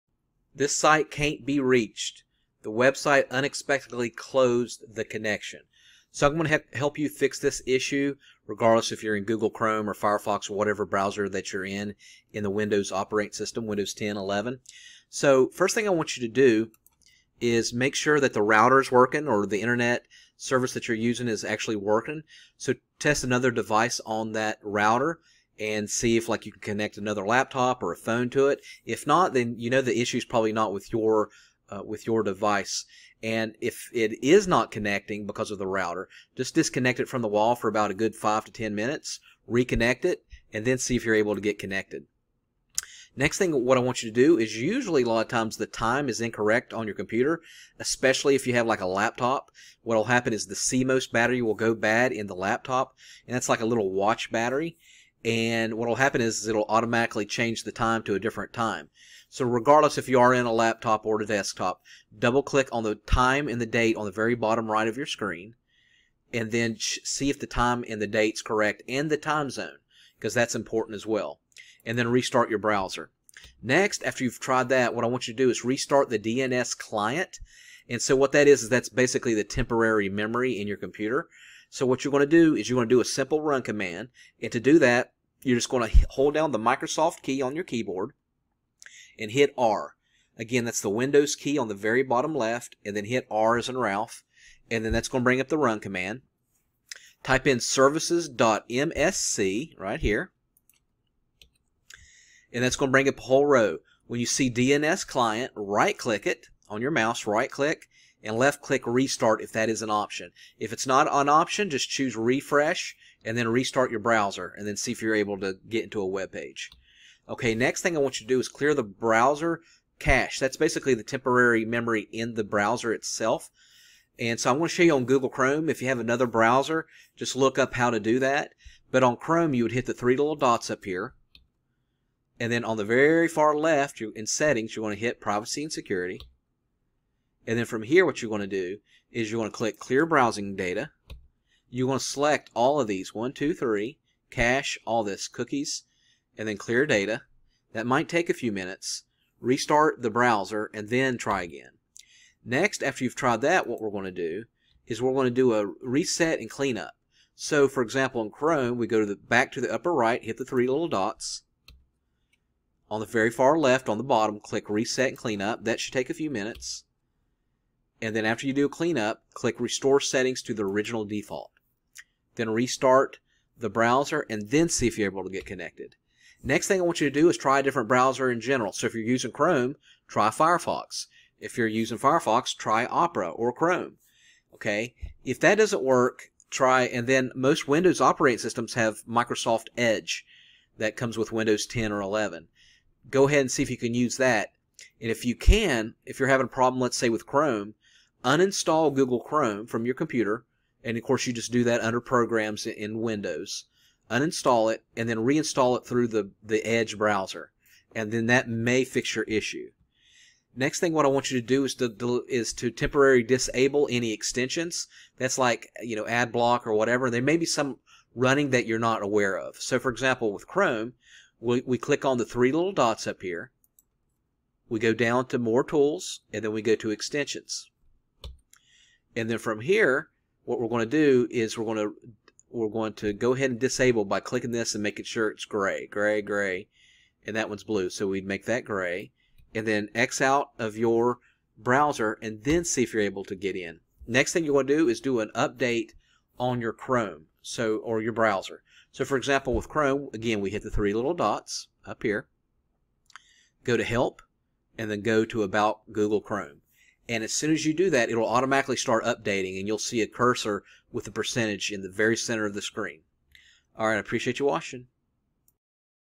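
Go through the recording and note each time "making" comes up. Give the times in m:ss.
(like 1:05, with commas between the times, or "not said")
3:54.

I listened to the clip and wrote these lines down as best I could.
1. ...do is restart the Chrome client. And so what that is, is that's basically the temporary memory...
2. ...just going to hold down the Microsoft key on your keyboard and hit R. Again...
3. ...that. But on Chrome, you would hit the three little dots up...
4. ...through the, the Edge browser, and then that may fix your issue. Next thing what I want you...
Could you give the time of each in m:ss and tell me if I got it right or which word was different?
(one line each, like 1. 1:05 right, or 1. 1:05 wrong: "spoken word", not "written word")
1. 1:15 wrong: "DNS", not "Chrome"
2. 1:25 right
3. 2:08 right
4. 3:25 right.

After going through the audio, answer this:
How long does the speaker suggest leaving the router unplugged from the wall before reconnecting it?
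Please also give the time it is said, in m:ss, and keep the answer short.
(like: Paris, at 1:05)
5 to 10 minutes, at 0:38.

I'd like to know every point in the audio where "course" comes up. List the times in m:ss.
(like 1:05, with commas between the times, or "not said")
3:21.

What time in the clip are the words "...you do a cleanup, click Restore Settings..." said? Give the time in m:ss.
2:48.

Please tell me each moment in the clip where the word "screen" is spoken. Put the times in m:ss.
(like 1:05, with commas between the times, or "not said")
1:05, 4:22.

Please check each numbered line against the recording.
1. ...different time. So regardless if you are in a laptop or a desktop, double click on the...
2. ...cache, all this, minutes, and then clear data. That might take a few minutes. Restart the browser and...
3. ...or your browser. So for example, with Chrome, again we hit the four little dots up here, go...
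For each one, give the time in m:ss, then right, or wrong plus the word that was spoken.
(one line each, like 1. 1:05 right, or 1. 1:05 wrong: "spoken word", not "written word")
1. 0:58 right
2. 2:24 wrong: "cookies", not "minutes"
3. 4:07 wrong: "three", not "four".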